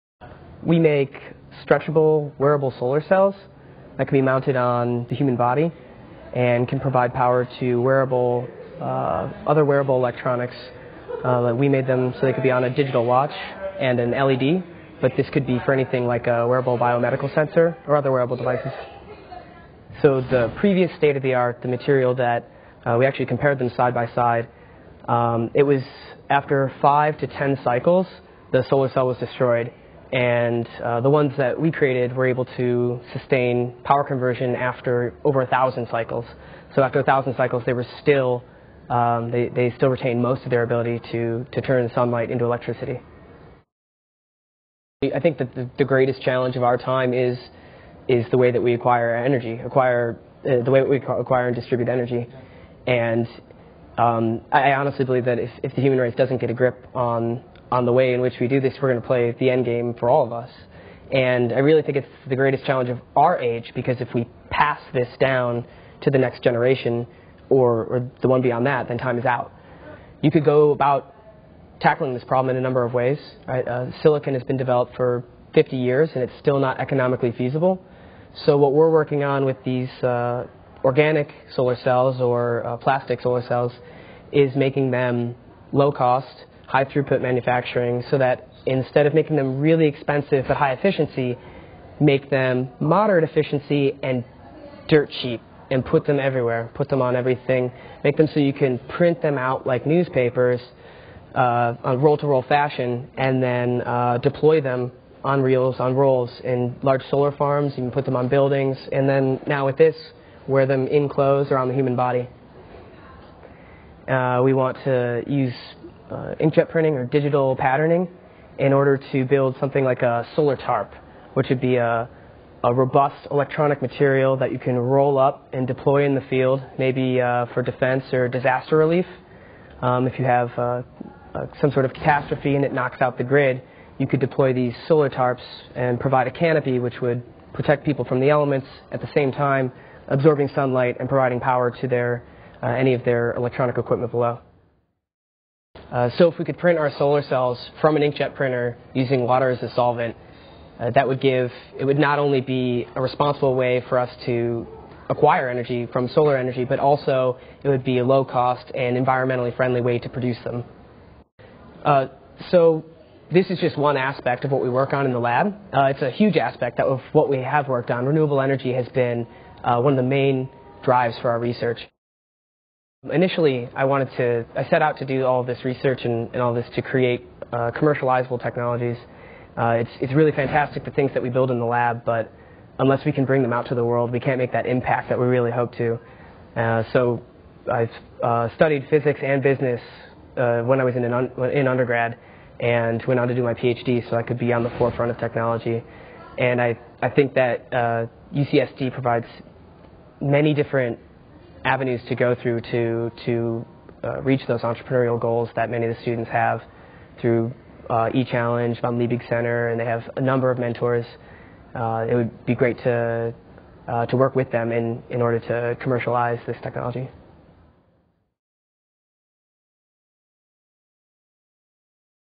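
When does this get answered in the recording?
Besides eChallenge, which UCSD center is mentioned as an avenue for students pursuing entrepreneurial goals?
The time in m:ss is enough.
3:28.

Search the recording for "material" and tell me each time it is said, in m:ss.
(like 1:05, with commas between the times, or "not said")
0:21, 2:03.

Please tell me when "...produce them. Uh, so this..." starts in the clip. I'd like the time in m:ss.
2:40.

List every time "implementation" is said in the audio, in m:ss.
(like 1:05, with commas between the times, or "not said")
not said.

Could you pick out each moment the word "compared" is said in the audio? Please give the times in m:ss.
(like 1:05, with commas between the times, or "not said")
0:23.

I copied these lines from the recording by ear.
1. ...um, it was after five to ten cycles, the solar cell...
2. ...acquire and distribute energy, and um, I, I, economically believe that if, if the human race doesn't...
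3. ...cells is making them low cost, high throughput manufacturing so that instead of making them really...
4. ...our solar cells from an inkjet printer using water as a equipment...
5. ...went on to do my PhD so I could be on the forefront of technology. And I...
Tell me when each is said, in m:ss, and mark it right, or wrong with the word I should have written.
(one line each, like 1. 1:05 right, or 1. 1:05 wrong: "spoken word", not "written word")
1. 0:25 right
2. 0:50 wrong: "honestly", not "economically"
3. 1:23 right
4. 2:26 wrong: "solvent", not "equipment"
5. 3:13 right.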